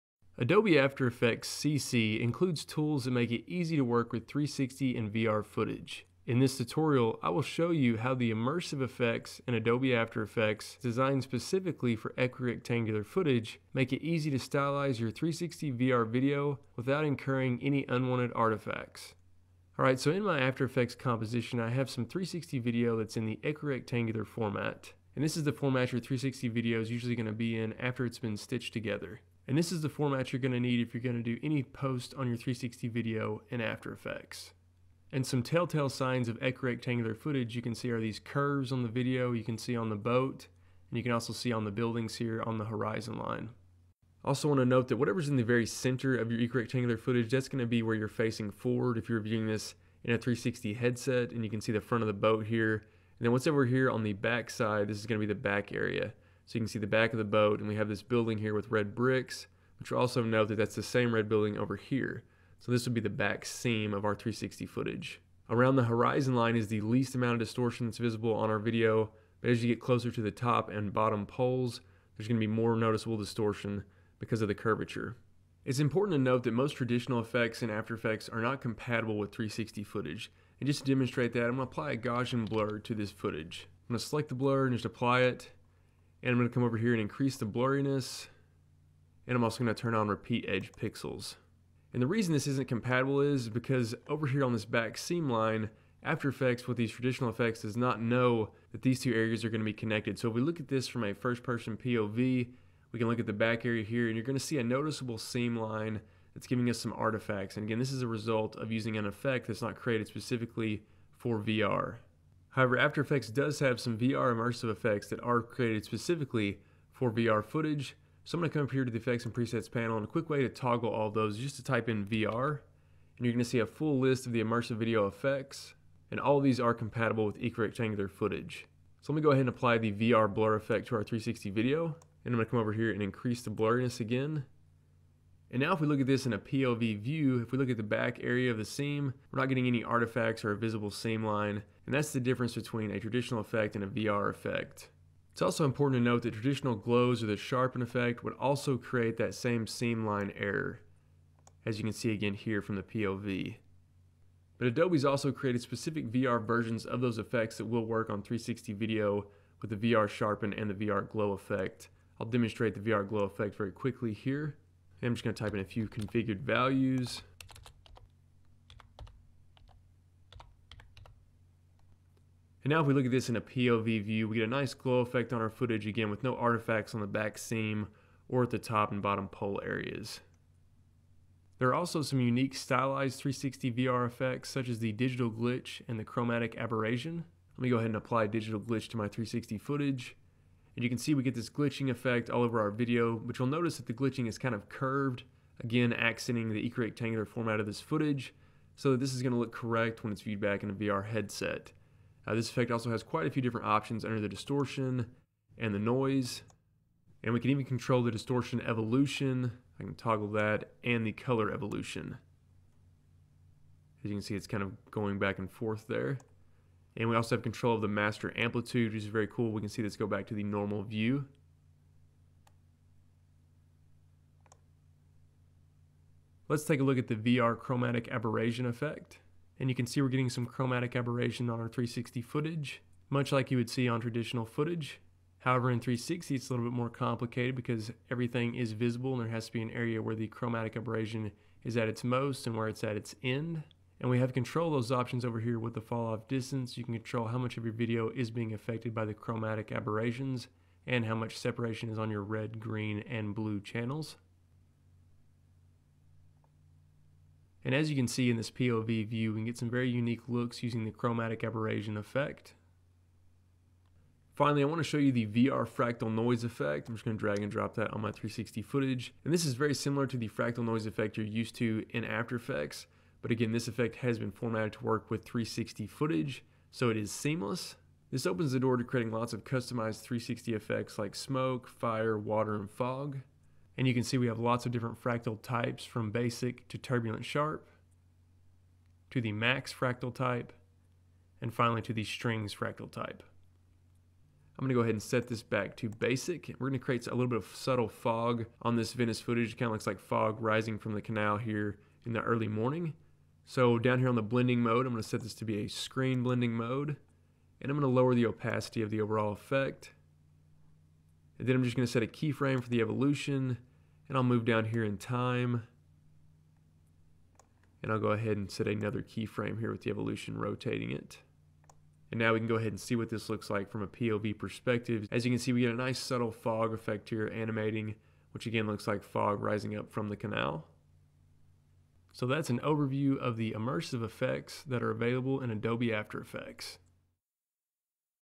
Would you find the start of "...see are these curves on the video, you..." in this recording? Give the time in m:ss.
0:37.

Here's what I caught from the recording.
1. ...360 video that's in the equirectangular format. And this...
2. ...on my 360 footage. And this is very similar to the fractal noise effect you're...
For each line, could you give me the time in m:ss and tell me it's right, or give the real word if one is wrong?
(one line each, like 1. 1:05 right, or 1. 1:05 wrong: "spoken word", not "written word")
1. 0:22 right
2. 4:27 right.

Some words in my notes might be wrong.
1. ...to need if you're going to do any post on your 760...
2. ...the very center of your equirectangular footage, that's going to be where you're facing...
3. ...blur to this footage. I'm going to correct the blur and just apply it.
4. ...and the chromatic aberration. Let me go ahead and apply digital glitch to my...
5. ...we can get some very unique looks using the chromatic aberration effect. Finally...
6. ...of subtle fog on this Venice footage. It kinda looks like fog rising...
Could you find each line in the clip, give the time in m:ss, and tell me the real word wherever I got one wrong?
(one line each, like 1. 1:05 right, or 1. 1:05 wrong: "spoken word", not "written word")
1. 0:30 wrong: "360", not "760"
2. 0:45 right
3. 1:22 wrong: "select", not "correct"
4. 3:05 right
5. 4:19 right
6. 4:57 right.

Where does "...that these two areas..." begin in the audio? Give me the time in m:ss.
1:38.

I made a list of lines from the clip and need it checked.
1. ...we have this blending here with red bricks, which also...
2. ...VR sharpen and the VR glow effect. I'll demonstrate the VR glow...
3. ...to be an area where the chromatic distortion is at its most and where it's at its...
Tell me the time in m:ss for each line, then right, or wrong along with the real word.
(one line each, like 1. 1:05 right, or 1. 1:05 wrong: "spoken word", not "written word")
1. 0:57 wrong: "building", not "blending"
2. 2:39 right
3. 3:59 wrong: "aberration", not "distortion".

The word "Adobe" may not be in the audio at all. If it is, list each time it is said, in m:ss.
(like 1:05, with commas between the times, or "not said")
0:00, 0:09, 2:34, 5:35.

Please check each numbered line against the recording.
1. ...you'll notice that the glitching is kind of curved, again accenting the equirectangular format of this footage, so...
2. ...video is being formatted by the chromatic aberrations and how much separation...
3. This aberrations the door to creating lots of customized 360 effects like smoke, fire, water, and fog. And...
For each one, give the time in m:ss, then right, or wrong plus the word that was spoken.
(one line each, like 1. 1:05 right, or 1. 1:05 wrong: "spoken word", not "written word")
1. 3:13 right
2. 4:07 wrong: "affected", not "formatted"
3. 4:38 wrong: "opens", not "aberrations".